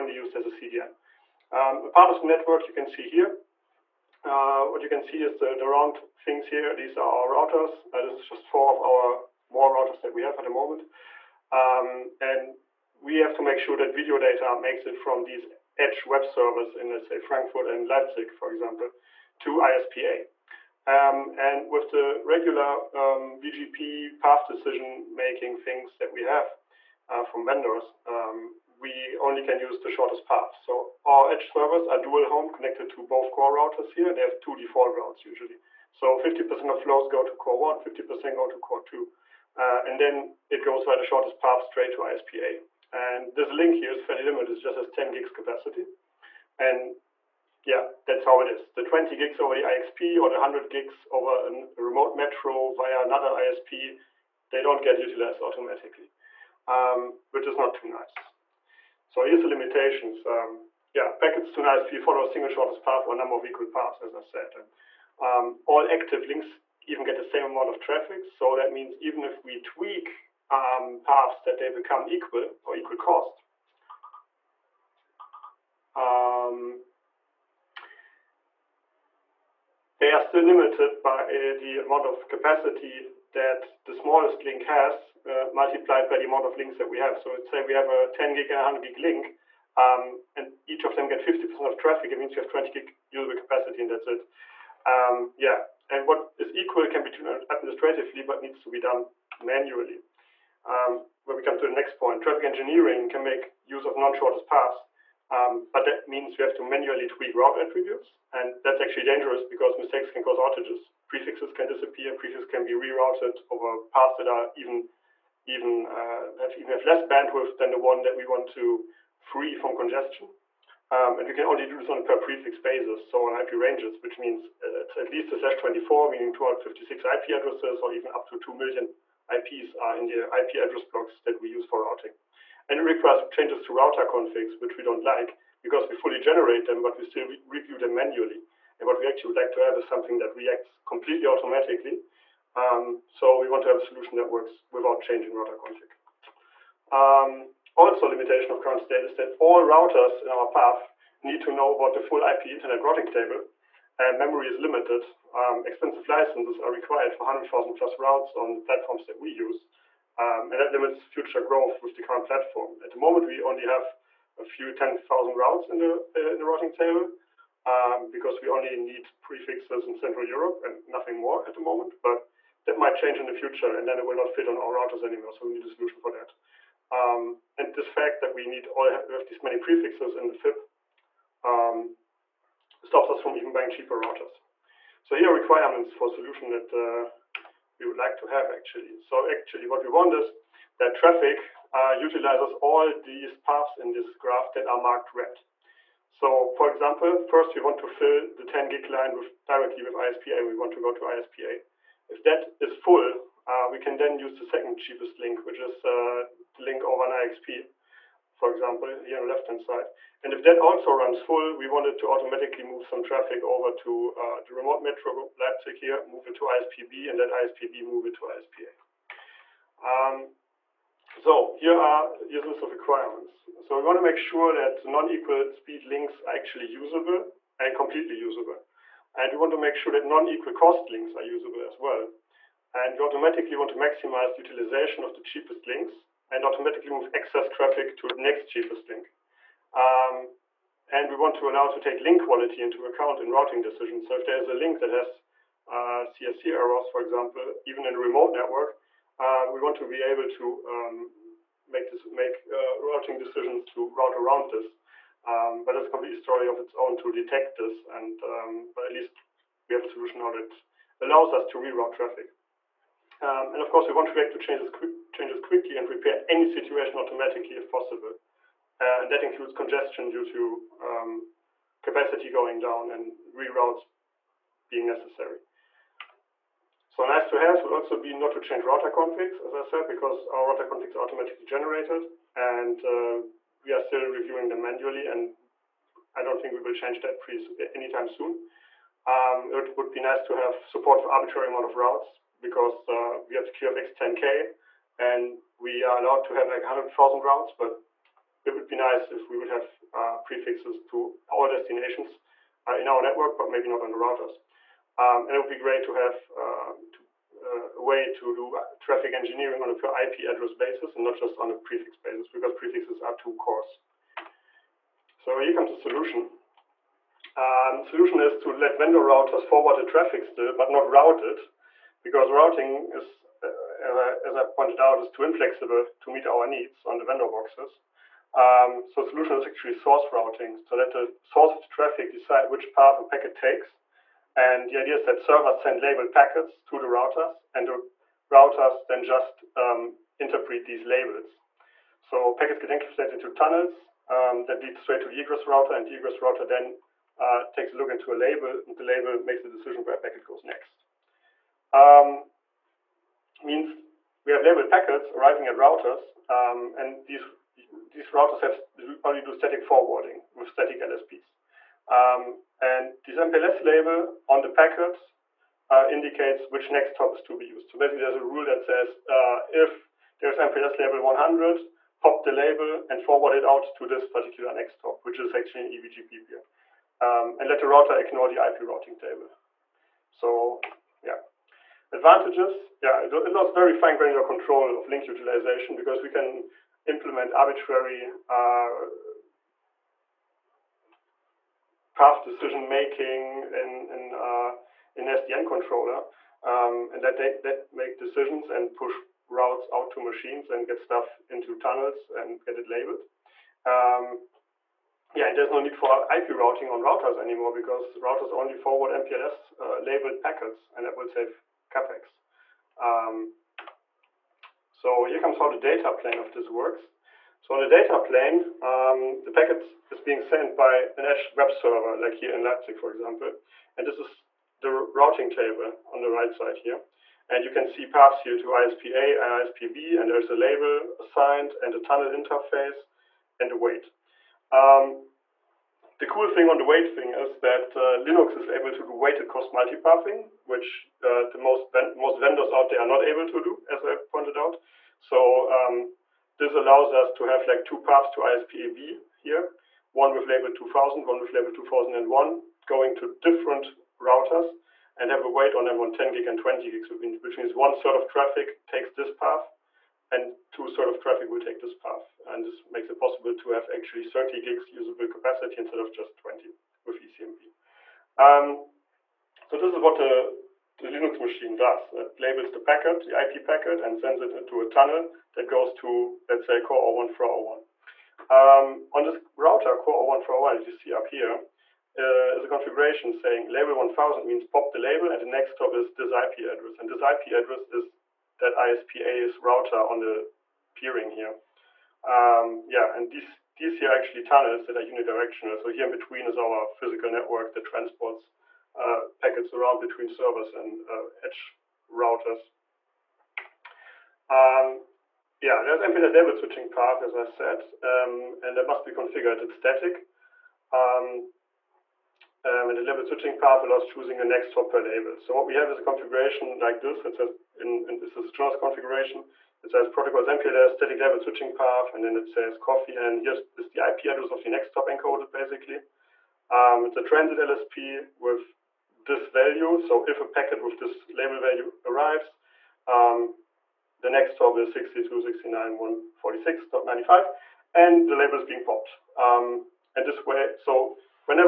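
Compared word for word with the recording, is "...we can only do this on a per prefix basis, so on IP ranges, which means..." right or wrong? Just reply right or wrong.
right.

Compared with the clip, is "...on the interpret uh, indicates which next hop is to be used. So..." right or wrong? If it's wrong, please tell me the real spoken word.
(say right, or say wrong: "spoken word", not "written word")
wrong: "packet", not "interpret".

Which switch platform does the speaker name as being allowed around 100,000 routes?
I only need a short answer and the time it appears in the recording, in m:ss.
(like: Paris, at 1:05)
QFX 10K, at 4:53.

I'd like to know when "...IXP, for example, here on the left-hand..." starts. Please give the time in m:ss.
3:27.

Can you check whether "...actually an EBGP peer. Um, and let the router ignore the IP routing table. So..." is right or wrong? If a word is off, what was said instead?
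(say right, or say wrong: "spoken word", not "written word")
right.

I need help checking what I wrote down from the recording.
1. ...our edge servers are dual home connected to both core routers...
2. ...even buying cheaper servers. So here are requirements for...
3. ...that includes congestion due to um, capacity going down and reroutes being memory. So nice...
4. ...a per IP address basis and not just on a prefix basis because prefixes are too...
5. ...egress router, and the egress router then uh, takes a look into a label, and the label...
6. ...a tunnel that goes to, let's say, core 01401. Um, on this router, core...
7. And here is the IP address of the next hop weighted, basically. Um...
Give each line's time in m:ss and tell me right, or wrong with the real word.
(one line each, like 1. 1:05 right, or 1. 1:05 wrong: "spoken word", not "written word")
1. 0:31 right
2. 3:03 wrong: "routers", not "servers"
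3. 4:29 wrong: "necessary", not "memory"
4. 5:09 right
5. 5:45 right
6. 7:54 right
7. 8:42 wrong: "encoded", not "weighted".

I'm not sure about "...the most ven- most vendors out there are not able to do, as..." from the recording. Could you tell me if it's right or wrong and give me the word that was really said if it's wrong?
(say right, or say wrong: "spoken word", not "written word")
right.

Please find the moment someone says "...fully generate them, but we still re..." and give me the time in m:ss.
2:15.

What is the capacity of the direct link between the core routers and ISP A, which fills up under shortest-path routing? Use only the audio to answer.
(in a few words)
10 gigs.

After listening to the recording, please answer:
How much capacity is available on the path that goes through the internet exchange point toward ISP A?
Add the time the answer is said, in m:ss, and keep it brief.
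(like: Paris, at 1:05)
20 gigs, at 0:48.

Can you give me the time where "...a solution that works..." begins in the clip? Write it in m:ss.
2:23.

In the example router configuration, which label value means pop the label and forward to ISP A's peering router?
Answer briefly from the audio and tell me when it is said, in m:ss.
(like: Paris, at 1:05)
1000, at 8:03.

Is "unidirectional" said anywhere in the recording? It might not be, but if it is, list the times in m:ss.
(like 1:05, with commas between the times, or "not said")
8:14.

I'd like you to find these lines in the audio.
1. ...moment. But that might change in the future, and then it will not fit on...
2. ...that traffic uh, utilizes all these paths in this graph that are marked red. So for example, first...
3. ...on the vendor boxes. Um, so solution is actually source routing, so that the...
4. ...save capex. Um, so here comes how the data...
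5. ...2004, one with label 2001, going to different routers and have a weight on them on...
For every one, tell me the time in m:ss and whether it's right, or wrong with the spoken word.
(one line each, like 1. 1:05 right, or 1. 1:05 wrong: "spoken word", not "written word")
1. 2:51 right
2. 3:10 right
3. 5:26 right
4. 6:51 right
5. 7:30 wrong: "2000", not "2004".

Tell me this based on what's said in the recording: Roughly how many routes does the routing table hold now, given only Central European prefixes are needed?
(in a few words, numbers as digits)
a few 10,000.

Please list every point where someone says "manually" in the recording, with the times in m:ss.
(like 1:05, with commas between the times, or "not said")
1:39, 1:46, 2:17, 4:44.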